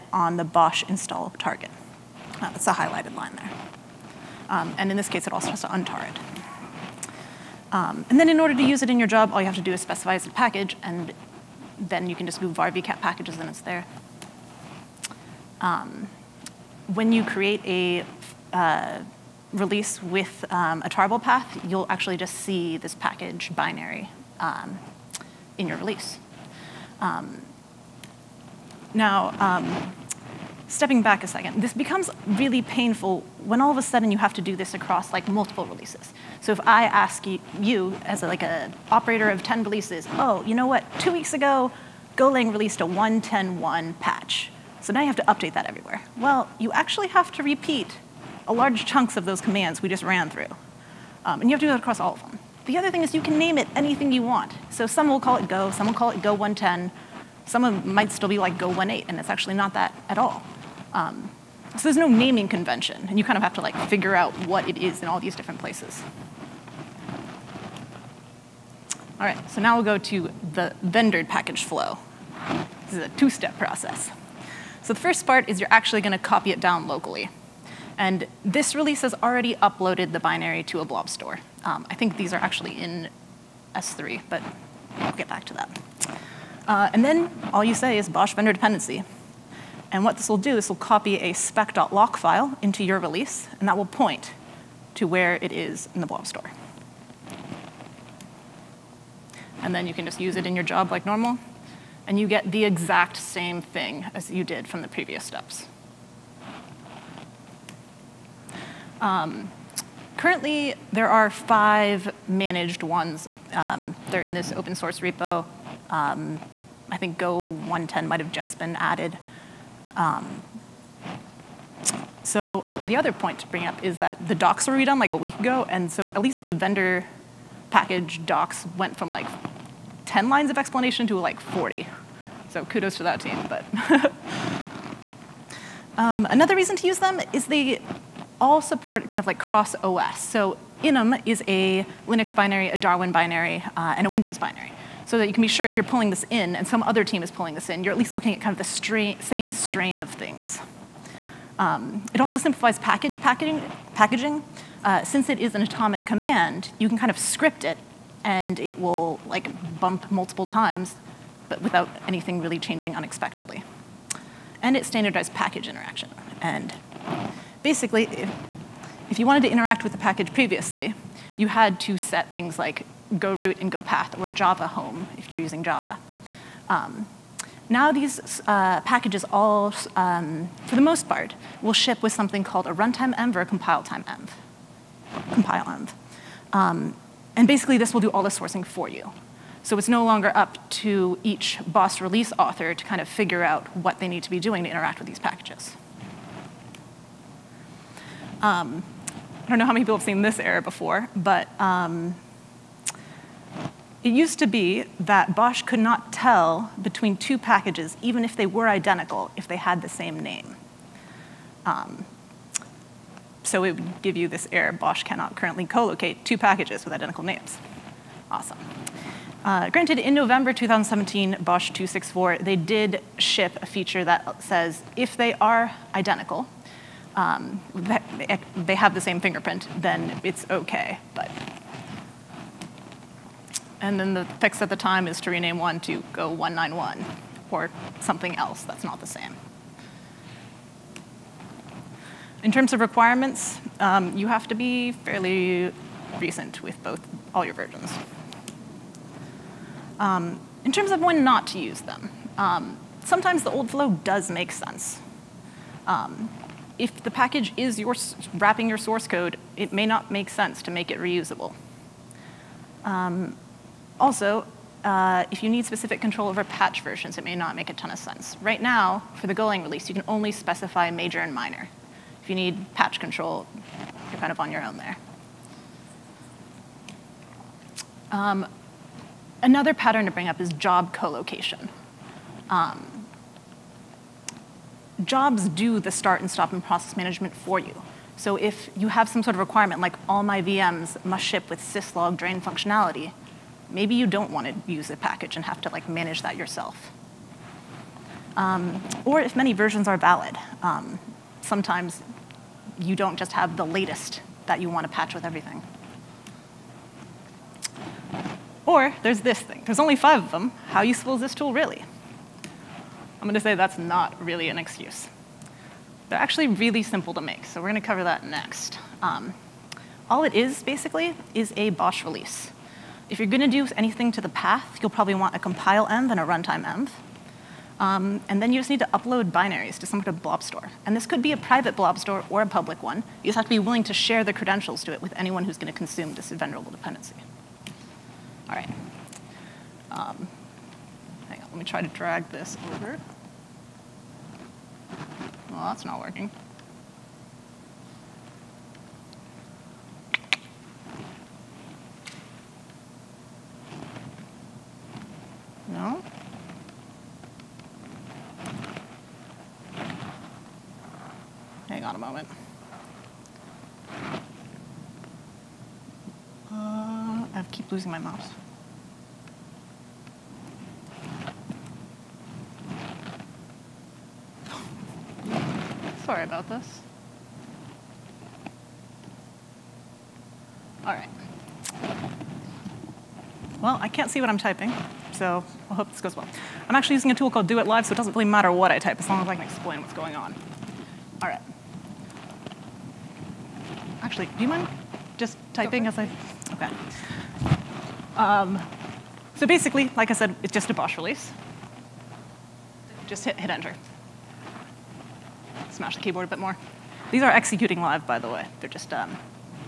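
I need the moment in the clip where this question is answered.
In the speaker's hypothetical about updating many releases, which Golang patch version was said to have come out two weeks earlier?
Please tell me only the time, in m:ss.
0:42.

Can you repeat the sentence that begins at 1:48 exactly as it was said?
Um, currently, there are five managed ones.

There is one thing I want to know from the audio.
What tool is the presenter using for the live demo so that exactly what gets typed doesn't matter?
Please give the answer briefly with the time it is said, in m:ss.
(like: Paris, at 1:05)
Do It Live, at 6:27.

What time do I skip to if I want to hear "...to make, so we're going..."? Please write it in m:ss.
5:17.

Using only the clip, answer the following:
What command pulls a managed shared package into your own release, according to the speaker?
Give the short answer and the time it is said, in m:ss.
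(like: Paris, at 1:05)
BOSH vendor dependency, at 1:28.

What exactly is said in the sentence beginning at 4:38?
Um, another pattern to bring up is job co-location.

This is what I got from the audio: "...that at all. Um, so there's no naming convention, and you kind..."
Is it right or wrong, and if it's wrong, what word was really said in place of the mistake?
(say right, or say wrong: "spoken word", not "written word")
right.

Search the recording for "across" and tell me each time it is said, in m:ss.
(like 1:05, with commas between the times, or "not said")
0:34, 0:51.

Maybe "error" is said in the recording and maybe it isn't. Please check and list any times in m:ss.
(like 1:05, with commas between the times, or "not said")
3:20, 3:34.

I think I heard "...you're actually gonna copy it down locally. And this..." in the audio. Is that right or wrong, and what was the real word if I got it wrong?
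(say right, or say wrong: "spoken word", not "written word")
right.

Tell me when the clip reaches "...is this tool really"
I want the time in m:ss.
5:11.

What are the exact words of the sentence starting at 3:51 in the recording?
But and then the fix at the time is to rename one to go 191 or something else that's not the same.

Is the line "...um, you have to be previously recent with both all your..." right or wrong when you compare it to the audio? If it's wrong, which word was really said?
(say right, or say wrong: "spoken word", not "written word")
wrong: "fairly", not "previously".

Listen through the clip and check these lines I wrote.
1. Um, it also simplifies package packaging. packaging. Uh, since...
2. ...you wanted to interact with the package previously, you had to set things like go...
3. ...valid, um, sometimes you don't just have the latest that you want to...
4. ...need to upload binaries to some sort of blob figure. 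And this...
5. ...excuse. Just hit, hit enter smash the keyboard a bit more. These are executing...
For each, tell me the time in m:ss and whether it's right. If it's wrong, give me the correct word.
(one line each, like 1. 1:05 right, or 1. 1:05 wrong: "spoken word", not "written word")
1. 2:31 right
2. 2:49 right
3. 4:59 right
4. 5:28 wrong: "store", not "figure"
5. 6:40 wrong: "release", not "excuse".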